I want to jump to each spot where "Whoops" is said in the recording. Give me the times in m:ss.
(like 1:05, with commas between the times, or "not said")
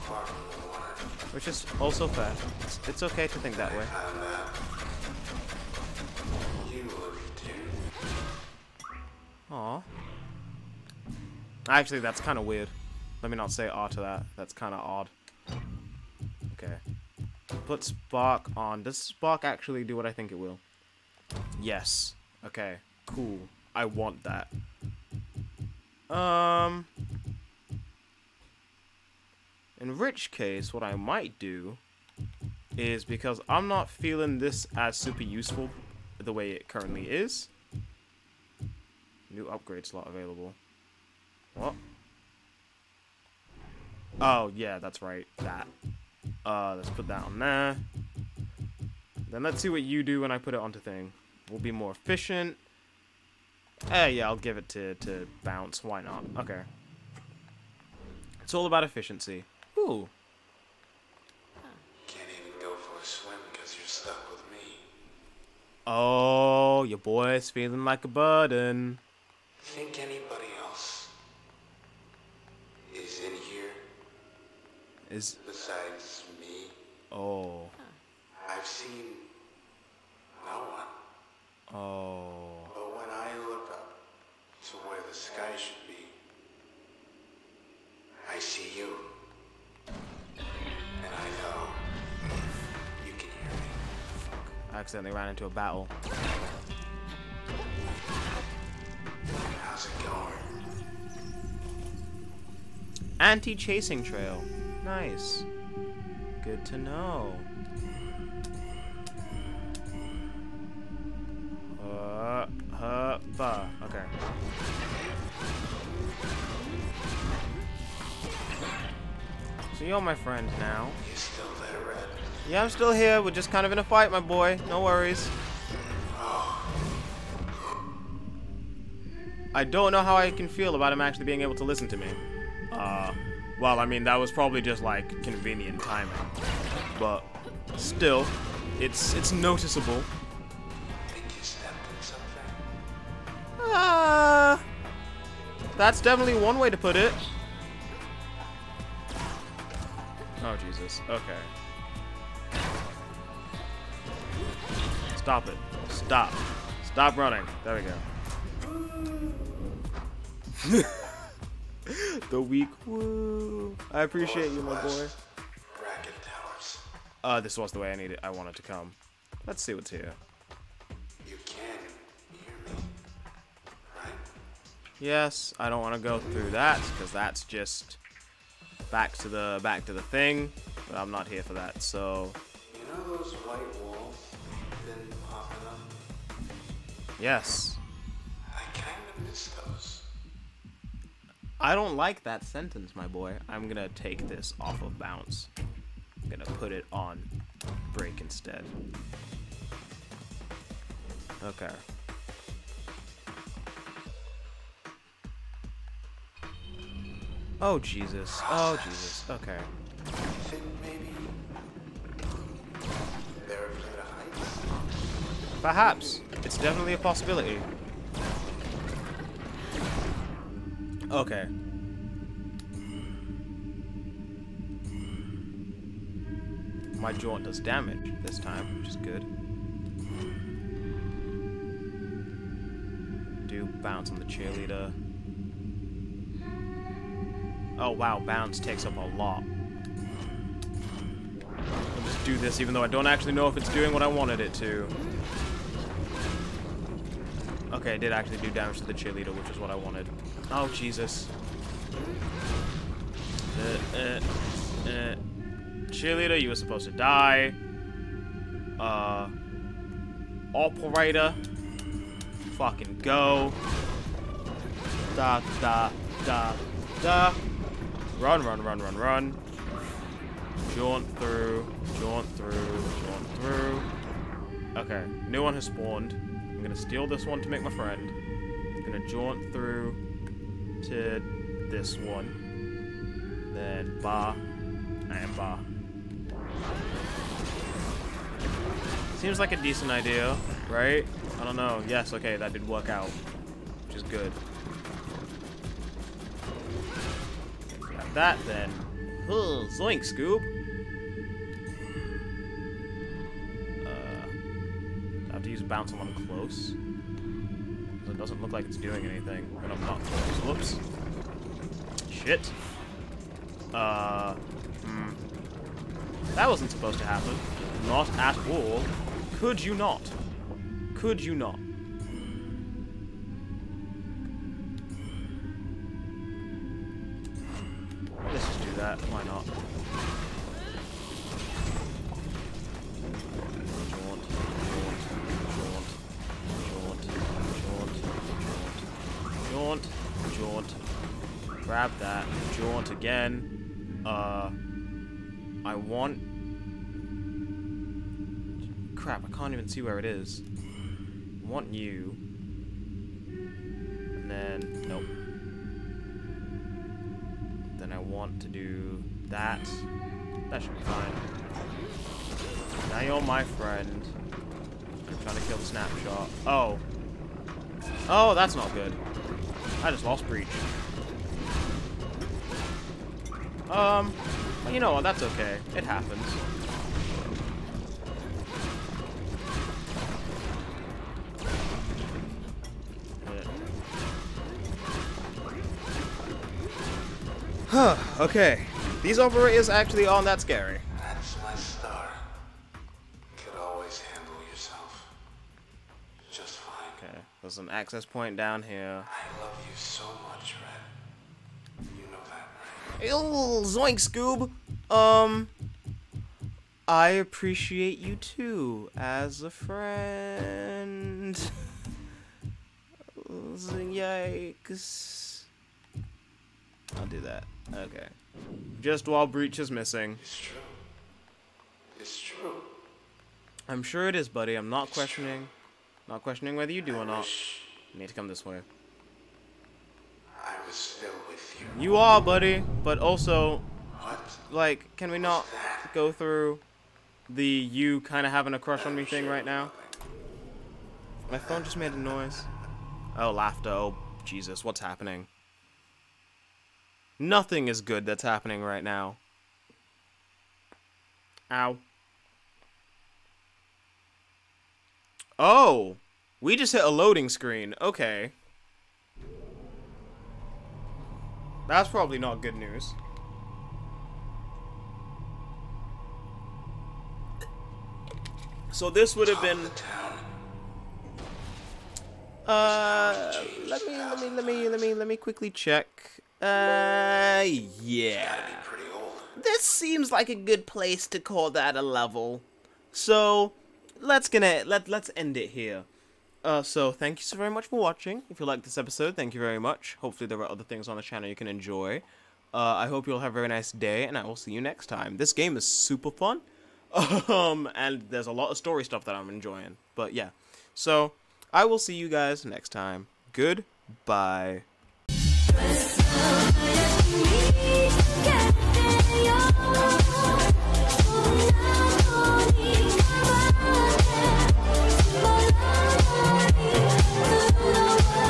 5:10.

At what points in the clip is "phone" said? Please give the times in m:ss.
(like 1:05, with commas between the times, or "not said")
7:21.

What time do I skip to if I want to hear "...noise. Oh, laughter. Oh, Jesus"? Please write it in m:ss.
7:21.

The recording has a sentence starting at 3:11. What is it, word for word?
I don't like that sentence, my boy.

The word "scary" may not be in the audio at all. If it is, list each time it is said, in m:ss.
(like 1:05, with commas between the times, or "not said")
6:30.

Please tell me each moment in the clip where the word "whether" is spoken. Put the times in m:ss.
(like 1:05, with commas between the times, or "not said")
7:06.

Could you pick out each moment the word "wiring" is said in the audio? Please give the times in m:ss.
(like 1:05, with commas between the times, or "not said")
not said.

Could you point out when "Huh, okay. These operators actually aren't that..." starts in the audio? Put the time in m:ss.
6:27.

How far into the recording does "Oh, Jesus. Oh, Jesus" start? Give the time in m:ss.
3:27.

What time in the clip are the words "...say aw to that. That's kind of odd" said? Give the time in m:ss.
0:13.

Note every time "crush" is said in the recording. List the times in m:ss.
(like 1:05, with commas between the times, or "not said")
7:18.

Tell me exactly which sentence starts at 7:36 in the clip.
We just hit a loading screen.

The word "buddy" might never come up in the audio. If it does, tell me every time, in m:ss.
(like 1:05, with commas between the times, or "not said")
7:04, 7:12.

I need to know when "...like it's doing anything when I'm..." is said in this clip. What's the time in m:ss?
5:08.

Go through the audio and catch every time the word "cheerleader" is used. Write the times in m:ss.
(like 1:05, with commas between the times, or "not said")
3:54, 4:08, 4:15.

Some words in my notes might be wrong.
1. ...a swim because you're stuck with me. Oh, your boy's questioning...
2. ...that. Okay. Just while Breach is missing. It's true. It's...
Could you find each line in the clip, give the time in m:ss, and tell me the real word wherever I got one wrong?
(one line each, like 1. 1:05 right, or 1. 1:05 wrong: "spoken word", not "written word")
1. 1:03 wrong: "feeling", not "questioning"
2. 6:57 right.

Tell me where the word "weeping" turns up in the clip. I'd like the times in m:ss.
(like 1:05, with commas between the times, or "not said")
not said.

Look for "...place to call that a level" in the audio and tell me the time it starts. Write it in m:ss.
8:00.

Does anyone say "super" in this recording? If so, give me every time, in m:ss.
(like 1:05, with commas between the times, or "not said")
0:34, 8:15.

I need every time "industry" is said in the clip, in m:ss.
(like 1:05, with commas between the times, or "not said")
not said.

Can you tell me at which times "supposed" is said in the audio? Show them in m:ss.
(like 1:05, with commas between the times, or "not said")
4:16, 5:16.